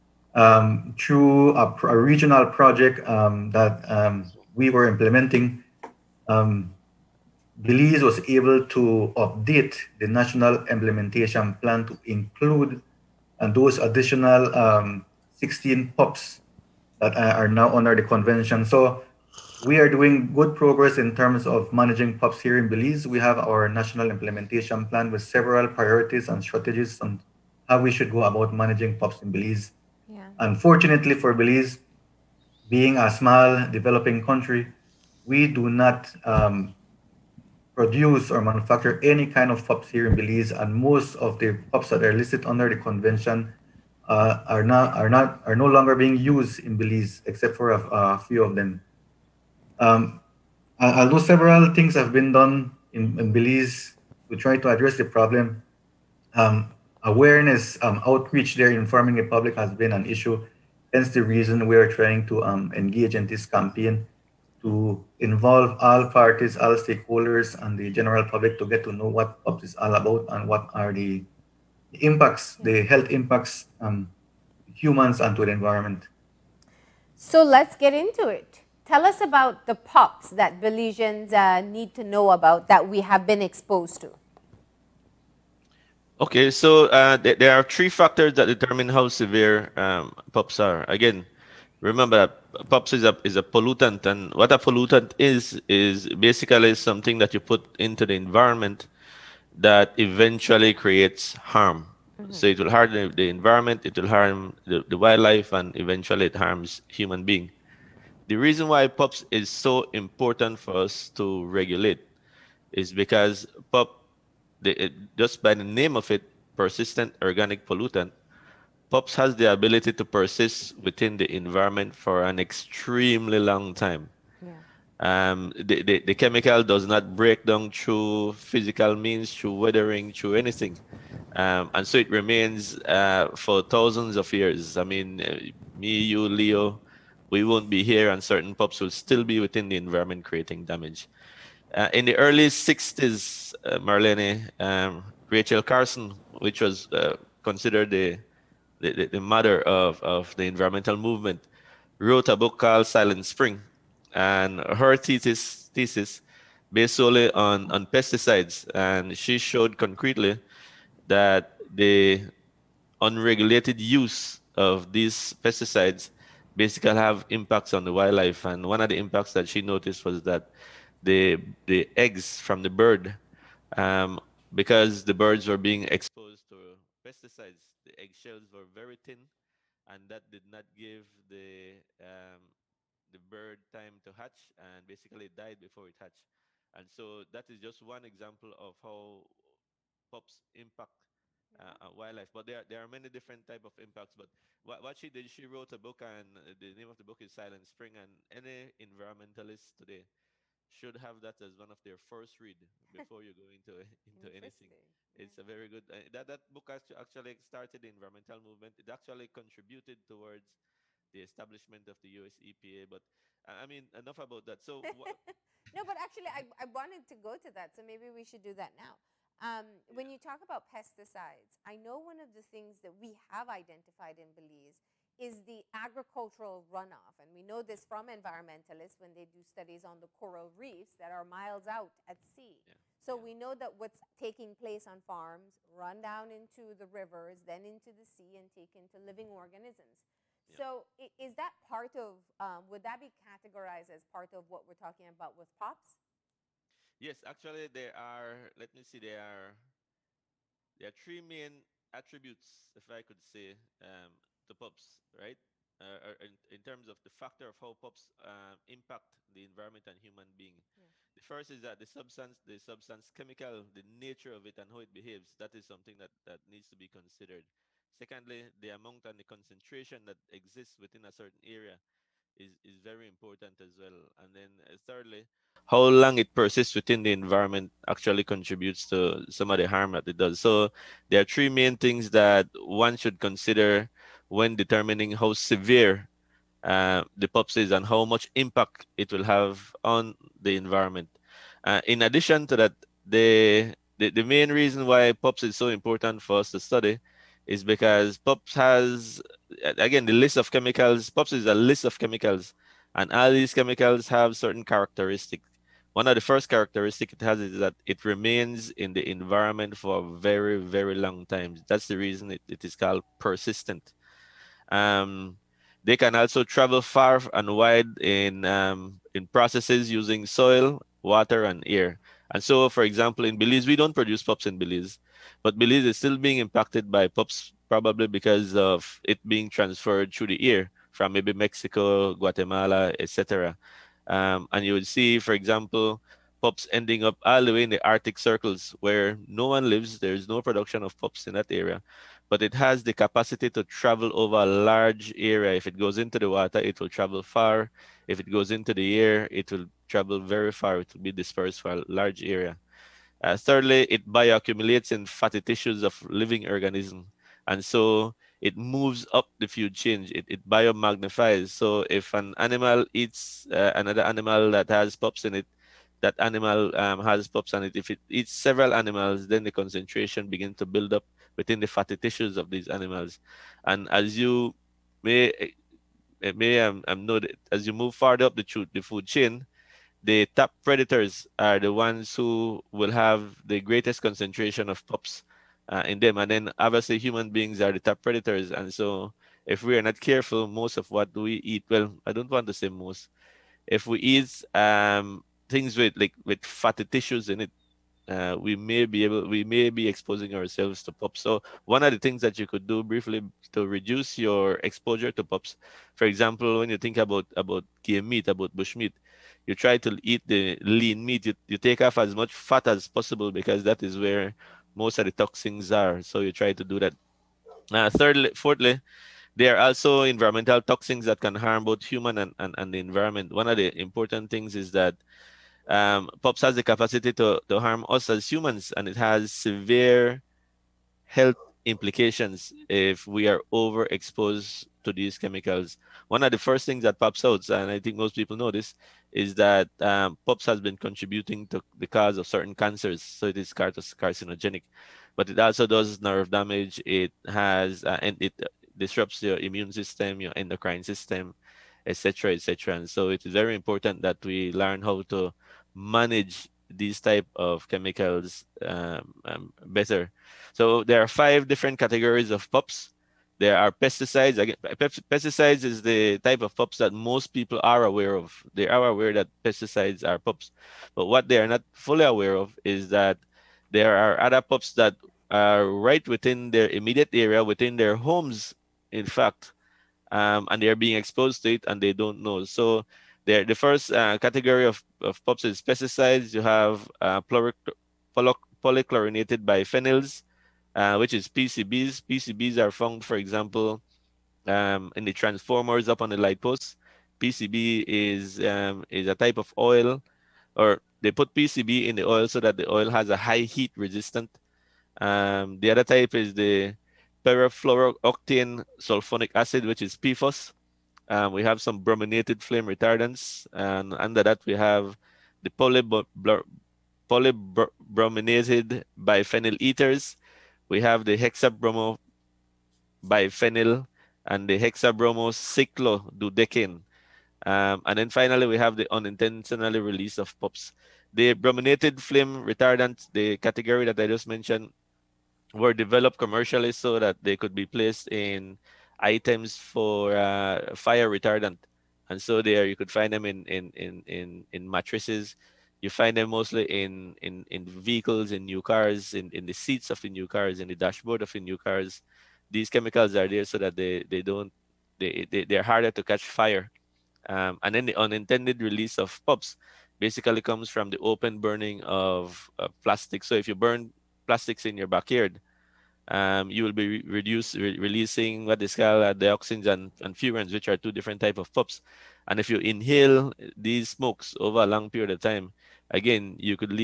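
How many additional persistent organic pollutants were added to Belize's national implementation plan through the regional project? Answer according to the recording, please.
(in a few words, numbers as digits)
16.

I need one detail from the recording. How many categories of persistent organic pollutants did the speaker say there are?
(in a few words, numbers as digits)
5.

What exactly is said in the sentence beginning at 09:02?
And so there you could find them in, in, in, in, in mattresses.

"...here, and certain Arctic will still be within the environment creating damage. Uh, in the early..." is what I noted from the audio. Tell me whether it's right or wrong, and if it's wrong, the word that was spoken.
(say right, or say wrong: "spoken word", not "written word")
wrong: "POPs", not "Arctic".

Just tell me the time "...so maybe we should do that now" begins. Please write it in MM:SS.
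03:37.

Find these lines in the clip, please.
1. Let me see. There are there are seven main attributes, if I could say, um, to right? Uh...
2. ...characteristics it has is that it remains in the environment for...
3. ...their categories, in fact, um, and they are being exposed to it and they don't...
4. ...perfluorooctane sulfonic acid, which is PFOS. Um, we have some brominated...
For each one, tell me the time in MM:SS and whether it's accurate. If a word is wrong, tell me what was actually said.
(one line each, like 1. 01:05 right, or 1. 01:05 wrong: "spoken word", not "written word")
1. 04:08 wrong: "three", not "seven"
2. 05:06 right
3. 07:57 wrong: "homes", not "categories"
4. 08:27 right.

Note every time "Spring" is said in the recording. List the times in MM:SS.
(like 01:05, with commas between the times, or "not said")
02:33, 03:17.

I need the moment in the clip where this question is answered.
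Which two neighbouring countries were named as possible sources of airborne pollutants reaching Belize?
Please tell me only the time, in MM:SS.
05:31.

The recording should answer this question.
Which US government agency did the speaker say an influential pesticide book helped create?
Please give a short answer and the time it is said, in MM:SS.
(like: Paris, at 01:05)
U.S. EPA, at 03:32.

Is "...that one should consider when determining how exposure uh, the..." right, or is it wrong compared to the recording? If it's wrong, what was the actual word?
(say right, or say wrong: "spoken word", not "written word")
wrong: "severe", not "exposure".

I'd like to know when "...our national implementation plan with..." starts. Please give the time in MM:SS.
00:23.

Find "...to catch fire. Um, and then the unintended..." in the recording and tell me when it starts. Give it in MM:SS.
09:15.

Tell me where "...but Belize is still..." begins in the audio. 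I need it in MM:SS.
05:25.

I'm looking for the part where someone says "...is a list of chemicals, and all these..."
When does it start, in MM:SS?
05:01.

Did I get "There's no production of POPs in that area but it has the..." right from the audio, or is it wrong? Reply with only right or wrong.
right.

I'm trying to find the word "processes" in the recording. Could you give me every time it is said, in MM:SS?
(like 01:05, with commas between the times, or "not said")
05:19.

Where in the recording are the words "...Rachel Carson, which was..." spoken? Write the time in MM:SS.
02:25.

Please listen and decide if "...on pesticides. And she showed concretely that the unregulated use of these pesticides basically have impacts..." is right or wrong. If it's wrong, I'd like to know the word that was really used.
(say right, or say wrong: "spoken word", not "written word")
right.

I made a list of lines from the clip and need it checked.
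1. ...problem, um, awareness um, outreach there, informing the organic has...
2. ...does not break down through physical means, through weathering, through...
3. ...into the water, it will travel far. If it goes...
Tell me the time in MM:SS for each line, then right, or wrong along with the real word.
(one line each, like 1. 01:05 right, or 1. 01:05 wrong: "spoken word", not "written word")
1. 00:55 wrong: "public", not "organic"
2. 02:06 right
3. 05:45 right.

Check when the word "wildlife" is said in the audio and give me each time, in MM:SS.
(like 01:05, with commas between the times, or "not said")
01:44, 02:47, 03:11.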